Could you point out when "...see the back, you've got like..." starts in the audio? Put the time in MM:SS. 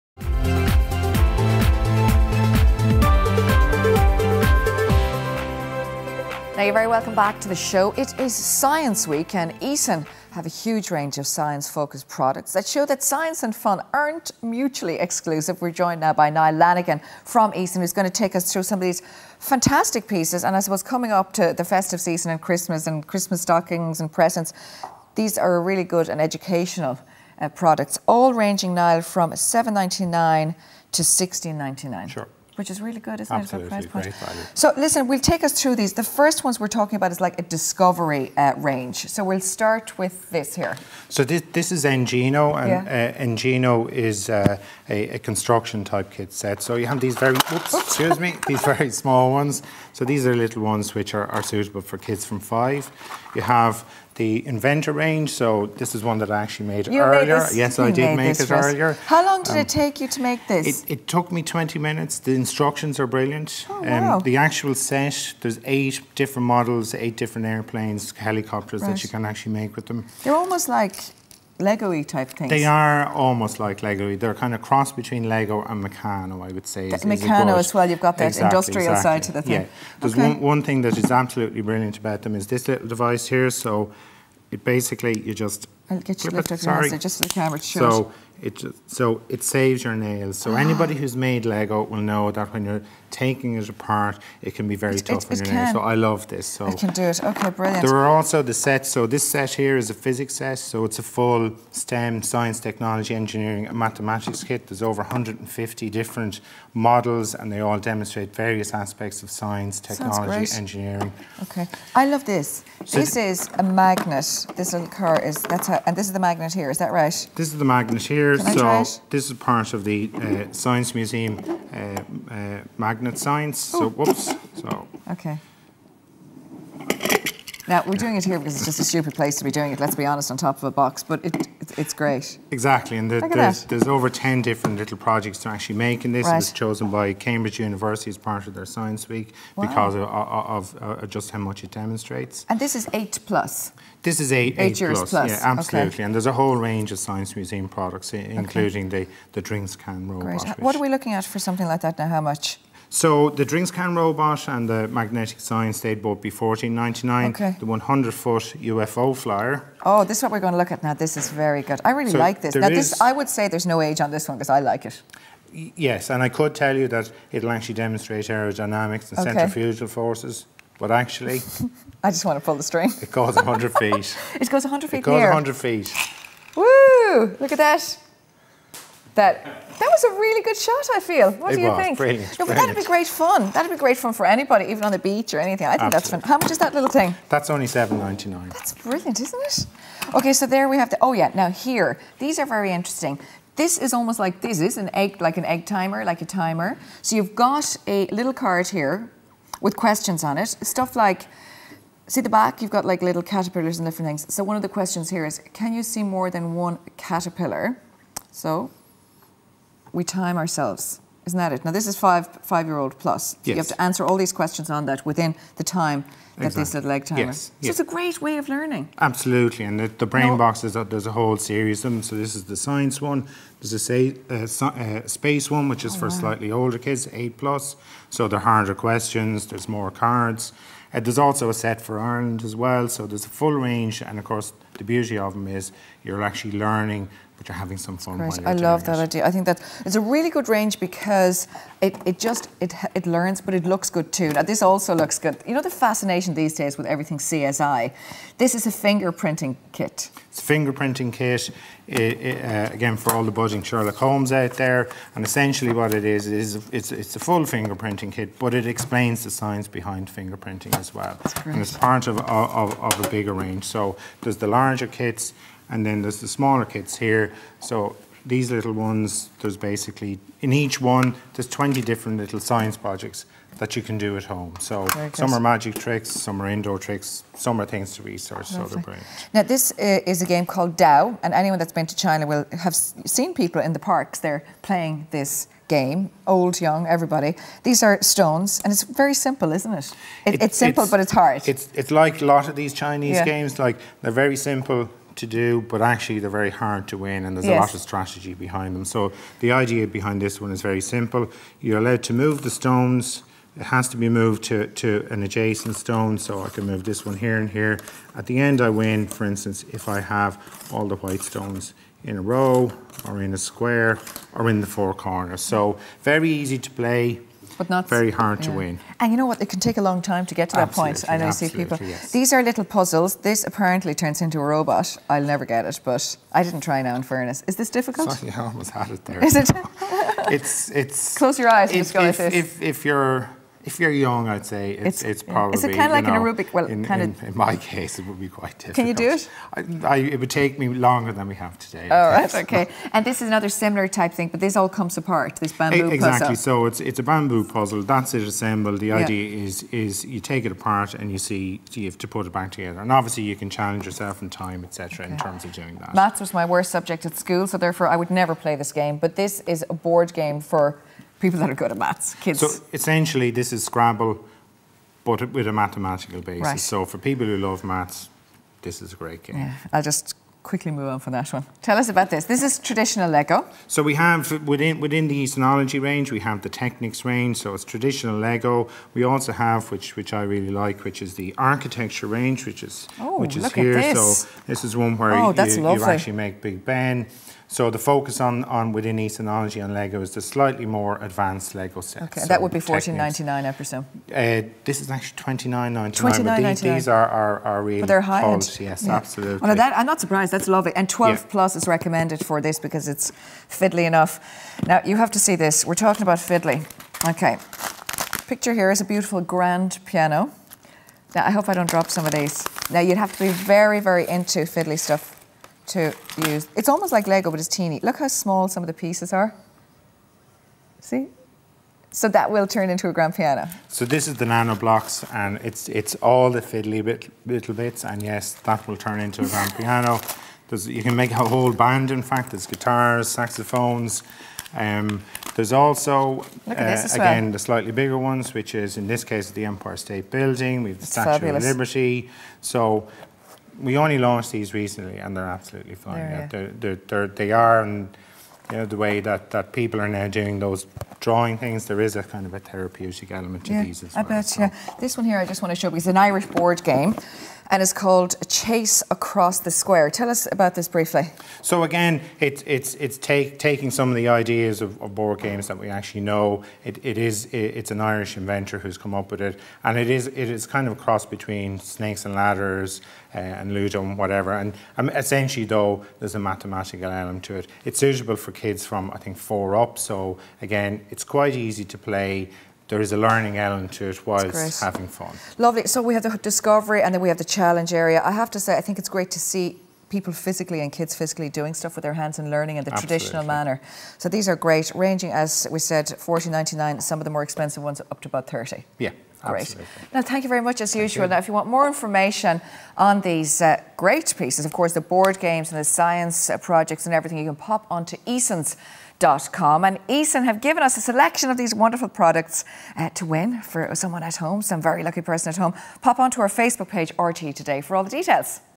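03:22.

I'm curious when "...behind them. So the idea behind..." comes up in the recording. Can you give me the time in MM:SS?
04:58.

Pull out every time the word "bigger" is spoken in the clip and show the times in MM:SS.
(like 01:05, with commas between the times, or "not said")
04:23, 07:17.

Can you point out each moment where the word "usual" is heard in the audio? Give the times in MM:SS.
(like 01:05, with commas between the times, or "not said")
08:20.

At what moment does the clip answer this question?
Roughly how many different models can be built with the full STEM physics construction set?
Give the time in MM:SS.
01:44.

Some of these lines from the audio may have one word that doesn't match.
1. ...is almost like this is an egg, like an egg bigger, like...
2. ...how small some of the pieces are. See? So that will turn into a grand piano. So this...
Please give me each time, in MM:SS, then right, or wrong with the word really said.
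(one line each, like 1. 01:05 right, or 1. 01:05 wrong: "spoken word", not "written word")
1. 03:13 wrong: "timer", not "bigger"
2. 06:57 right.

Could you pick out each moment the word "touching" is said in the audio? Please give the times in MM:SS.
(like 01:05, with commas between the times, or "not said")
not said.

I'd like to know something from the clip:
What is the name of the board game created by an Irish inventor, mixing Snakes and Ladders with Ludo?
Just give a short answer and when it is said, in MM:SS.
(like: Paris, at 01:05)
Chase Across the Square, at 07:38.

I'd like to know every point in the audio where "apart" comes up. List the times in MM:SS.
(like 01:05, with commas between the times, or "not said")
01:33, 05:44, 05:50.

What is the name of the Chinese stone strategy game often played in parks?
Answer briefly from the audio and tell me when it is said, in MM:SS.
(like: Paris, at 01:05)
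Dao, at 04:40.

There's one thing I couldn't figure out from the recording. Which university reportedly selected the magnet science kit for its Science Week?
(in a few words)
Cambridge University.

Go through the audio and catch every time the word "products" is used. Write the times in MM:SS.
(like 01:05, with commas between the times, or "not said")
00:12, 00:27, 02:27, 08:31.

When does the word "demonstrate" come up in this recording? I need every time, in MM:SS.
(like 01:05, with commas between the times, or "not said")
01:47, 02:21, 02:47.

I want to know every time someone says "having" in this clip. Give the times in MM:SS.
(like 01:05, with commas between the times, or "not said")
03:57, 08:04.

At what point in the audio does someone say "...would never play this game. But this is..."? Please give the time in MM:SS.
05:57.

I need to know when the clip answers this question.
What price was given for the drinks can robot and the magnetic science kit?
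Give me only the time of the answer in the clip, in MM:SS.
02:36.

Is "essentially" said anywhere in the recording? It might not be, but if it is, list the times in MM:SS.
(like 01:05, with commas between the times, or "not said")
04:15, 06:02, 07:54.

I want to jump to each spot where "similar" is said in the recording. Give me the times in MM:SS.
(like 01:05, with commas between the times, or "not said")
05:43.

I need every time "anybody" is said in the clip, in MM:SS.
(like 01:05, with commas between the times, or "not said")
01:30, 03:04.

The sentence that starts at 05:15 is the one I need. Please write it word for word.
So very easy to play, but not very hard yeah.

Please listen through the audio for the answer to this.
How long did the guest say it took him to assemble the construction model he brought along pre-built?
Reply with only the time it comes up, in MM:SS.
01:01.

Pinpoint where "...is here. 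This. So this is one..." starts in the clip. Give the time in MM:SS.
06:23.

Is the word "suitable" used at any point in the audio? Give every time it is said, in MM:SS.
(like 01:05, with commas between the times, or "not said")
00:51, 07:57.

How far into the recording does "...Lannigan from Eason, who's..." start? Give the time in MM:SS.
00:16.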